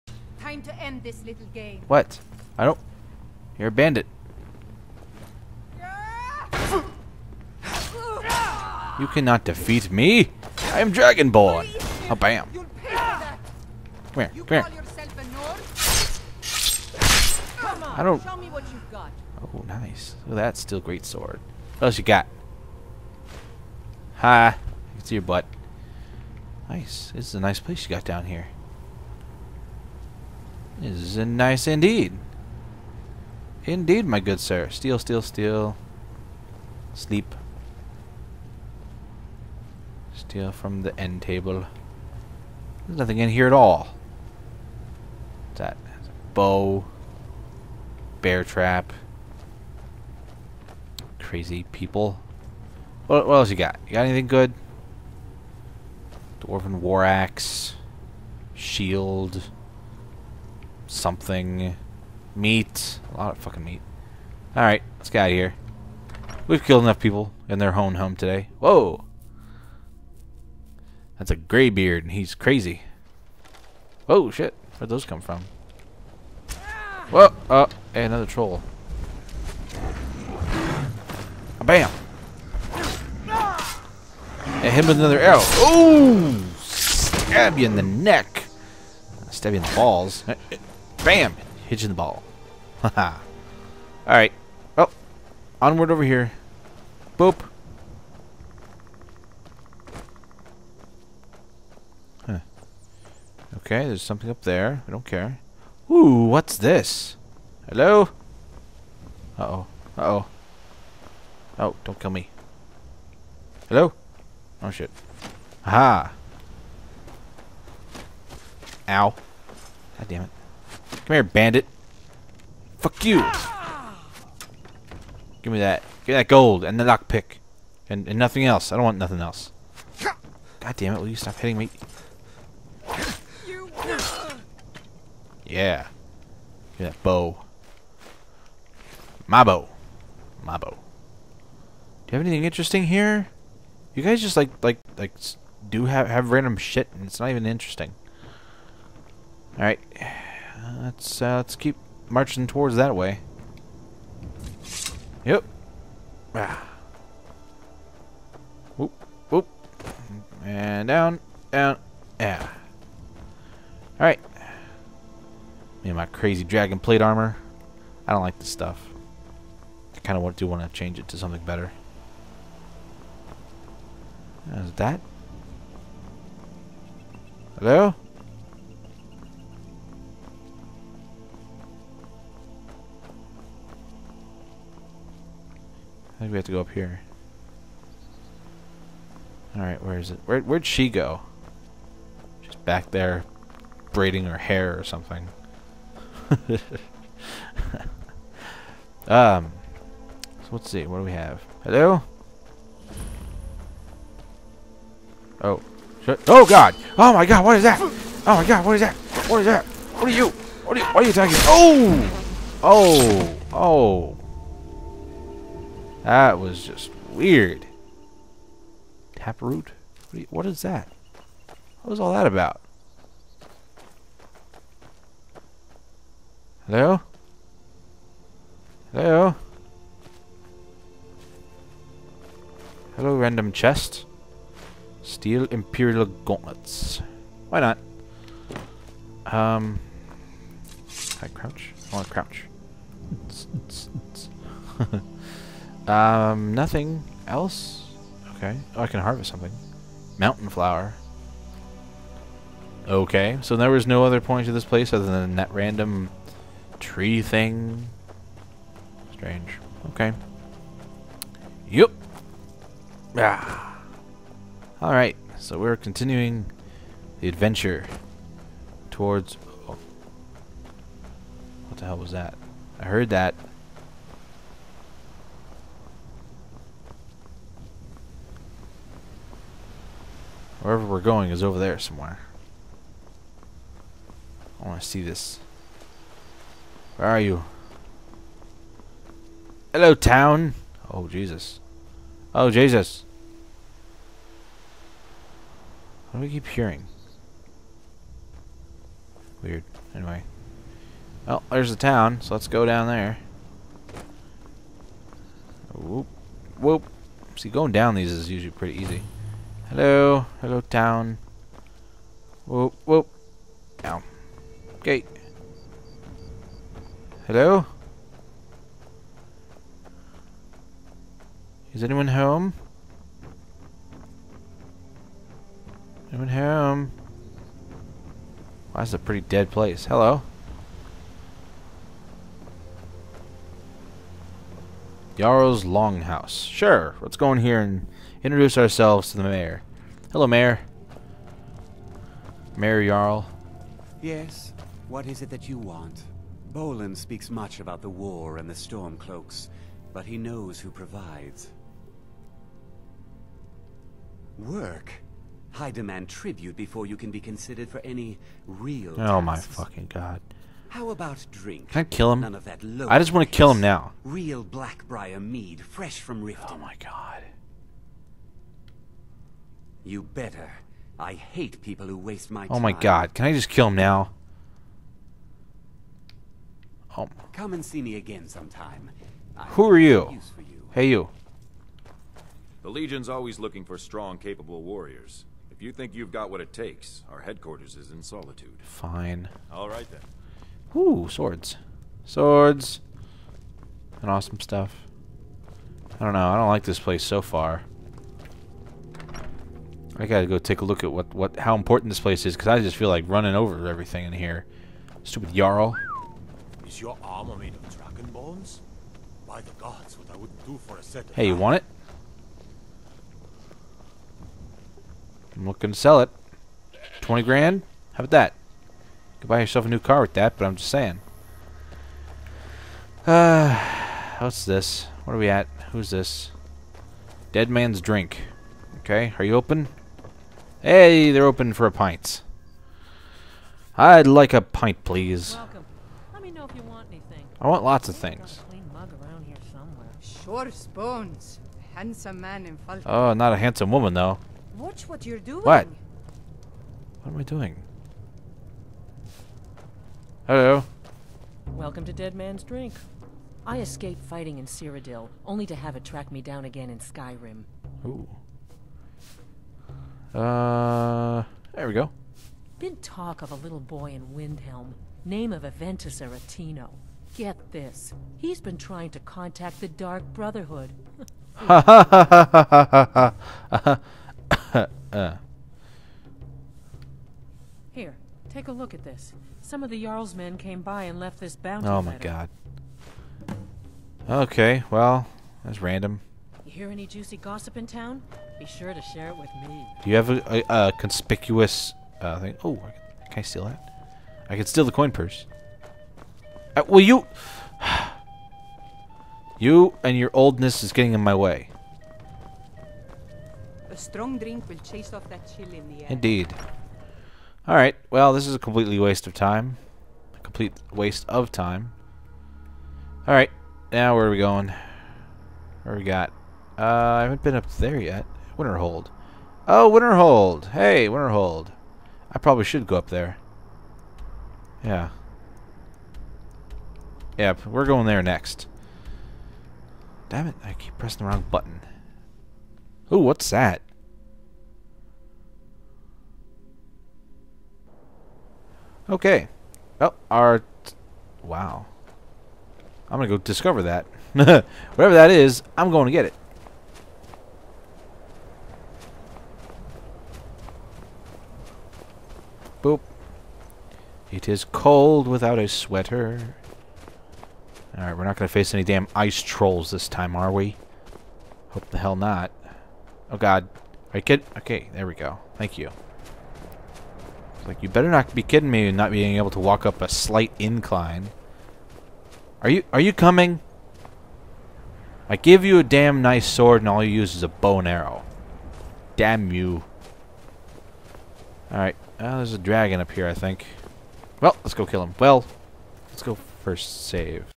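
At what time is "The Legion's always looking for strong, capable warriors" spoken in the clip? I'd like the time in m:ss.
6:22.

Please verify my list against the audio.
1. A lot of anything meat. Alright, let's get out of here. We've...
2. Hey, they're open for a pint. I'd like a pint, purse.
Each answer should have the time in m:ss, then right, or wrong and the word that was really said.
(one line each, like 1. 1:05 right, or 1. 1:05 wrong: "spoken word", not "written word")
1. 1:03 wrong: "fucking", not "anything"
2. 7:10 wrong: "please", not "purse".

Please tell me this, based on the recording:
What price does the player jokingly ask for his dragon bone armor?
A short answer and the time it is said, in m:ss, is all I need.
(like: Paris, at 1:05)
20 grand, at 6:57.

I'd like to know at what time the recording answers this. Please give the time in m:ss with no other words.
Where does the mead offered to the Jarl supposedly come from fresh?
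6:06.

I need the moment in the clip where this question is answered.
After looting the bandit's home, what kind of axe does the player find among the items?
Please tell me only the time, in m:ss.
0:56.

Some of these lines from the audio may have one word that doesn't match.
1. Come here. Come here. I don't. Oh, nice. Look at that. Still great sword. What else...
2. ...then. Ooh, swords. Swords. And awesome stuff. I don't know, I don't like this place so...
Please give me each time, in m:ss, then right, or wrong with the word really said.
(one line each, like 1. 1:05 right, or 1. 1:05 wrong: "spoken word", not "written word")
1. 0:12 right
2. 6:29 right.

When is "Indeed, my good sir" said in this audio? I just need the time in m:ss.
0:33.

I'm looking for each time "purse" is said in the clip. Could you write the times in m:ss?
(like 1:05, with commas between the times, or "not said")
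8:14.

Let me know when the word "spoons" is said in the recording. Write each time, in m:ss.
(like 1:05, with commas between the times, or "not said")
7:20.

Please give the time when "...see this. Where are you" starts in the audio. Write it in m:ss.
4:44.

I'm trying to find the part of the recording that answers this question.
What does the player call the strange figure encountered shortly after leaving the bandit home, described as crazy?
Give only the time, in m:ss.
1:11.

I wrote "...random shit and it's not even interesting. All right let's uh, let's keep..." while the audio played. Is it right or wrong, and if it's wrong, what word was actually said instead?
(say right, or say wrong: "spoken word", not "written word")
right.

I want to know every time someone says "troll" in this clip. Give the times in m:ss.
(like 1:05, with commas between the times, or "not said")
1:18, 9:19.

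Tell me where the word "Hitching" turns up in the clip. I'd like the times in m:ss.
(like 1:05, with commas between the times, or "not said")
1:31.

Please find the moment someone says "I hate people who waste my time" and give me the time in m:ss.
6:10.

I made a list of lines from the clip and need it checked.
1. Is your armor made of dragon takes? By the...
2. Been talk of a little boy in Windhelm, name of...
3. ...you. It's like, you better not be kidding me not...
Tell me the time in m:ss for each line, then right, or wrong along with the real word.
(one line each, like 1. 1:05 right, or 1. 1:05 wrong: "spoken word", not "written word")
1. 6:46 wrong: "bones", not "takes"
2. 7:42 right
3. 9:25 right.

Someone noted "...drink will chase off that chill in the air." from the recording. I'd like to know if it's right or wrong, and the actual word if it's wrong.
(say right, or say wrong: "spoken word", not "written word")
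right.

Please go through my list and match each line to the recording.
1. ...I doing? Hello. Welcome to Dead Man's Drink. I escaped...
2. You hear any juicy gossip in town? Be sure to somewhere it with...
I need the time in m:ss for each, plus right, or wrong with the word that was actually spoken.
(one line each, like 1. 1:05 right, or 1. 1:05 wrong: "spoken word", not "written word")
1. 7:27 right
2. 8:06 wrong: "share", not "somewhere".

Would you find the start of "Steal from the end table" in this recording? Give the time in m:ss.
0:40.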